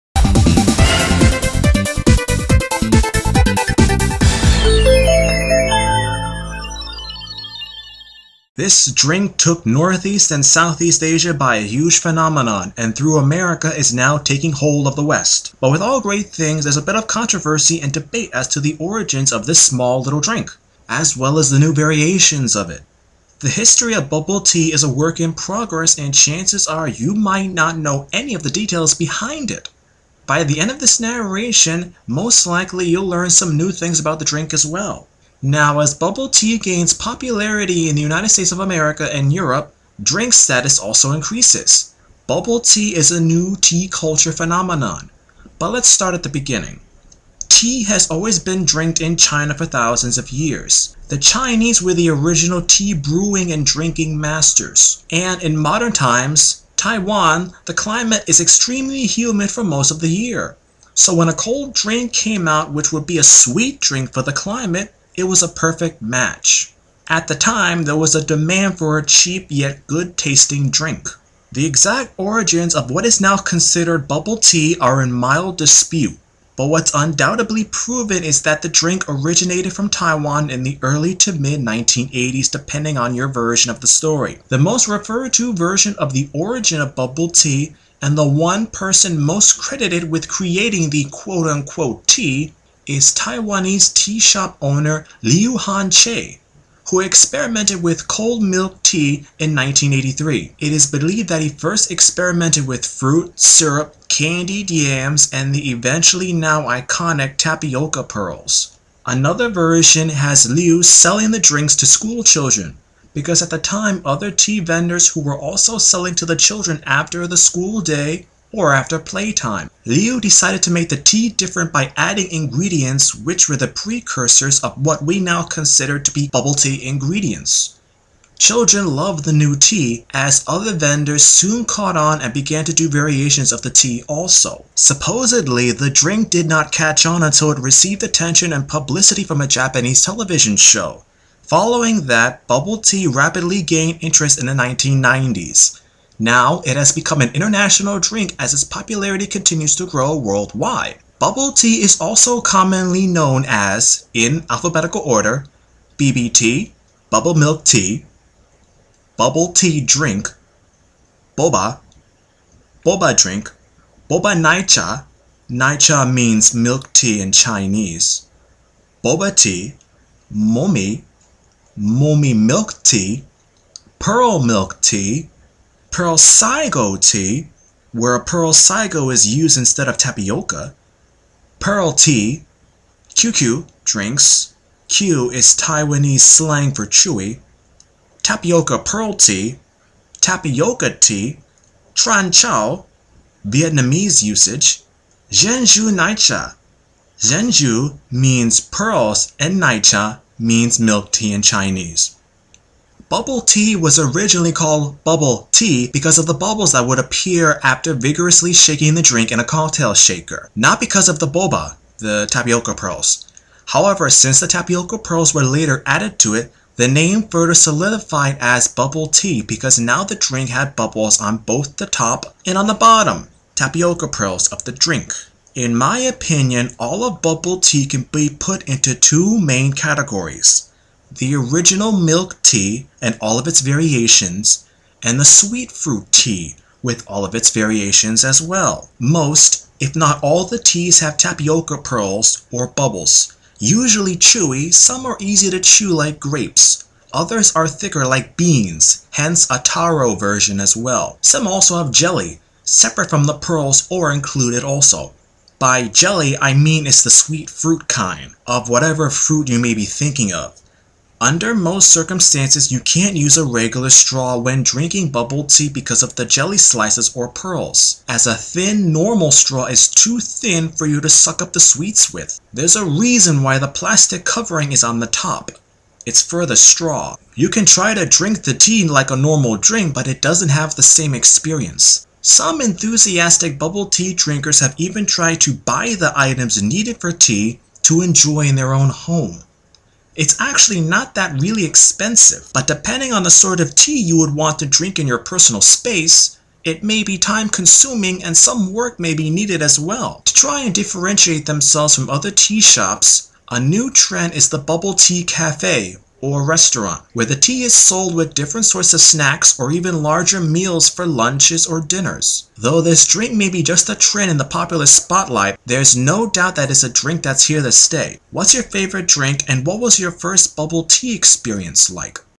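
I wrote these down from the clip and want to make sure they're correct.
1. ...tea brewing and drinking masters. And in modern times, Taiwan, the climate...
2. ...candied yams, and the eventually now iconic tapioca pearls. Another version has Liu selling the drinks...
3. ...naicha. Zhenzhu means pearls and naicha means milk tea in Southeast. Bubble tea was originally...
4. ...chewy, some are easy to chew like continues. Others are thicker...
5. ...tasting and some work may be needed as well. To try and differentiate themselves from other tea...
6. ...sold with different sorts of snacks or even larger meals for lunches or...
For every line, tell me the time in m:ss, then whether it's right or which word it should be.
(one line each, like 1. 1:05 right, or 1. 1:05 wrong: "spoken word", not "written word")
1. 0:52 right
2. 1:44 right
3. 3:15 wrong: "Chinese", not "Southeast"
4. 4:04 wrong: "grapes", not "continues"
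5. 4:57 wrong: "consuming", not "tasting"
6. 5:07 right.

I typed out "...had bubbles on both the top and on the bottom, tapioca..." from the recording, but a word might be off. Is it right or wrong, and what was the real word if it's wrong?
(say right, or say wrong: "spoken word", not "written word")
right.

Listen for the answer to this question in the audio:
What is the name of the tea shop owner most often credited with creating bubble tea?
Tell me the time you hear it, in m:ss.
1:35.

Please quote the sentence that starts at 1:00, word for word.
So when a cold drink came out, which would be a sweet drink for the climate, it was a perfect match.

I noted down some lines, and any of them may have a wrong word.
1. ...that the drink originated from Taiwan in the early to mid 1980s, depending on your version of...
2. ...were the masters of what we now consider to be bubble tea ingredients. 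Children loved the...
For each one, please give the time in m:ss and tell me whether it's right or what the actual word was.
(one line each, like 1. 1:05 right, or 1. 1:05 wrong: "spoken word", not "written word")
1. 1:18 right
2. 2:03 wrong: "precursors", not "masters".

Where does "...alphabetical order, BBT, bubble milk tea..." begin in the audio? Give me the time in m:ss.
2:34.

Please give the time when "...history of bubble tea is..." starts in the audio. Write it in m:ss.
0:23.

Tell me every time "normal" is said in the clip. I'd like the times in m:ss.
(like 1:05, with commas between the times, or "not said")
4:28, 4:39.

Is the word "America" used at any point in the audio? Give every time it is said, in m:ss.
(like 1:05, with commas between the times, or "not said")
0:13, 0:38.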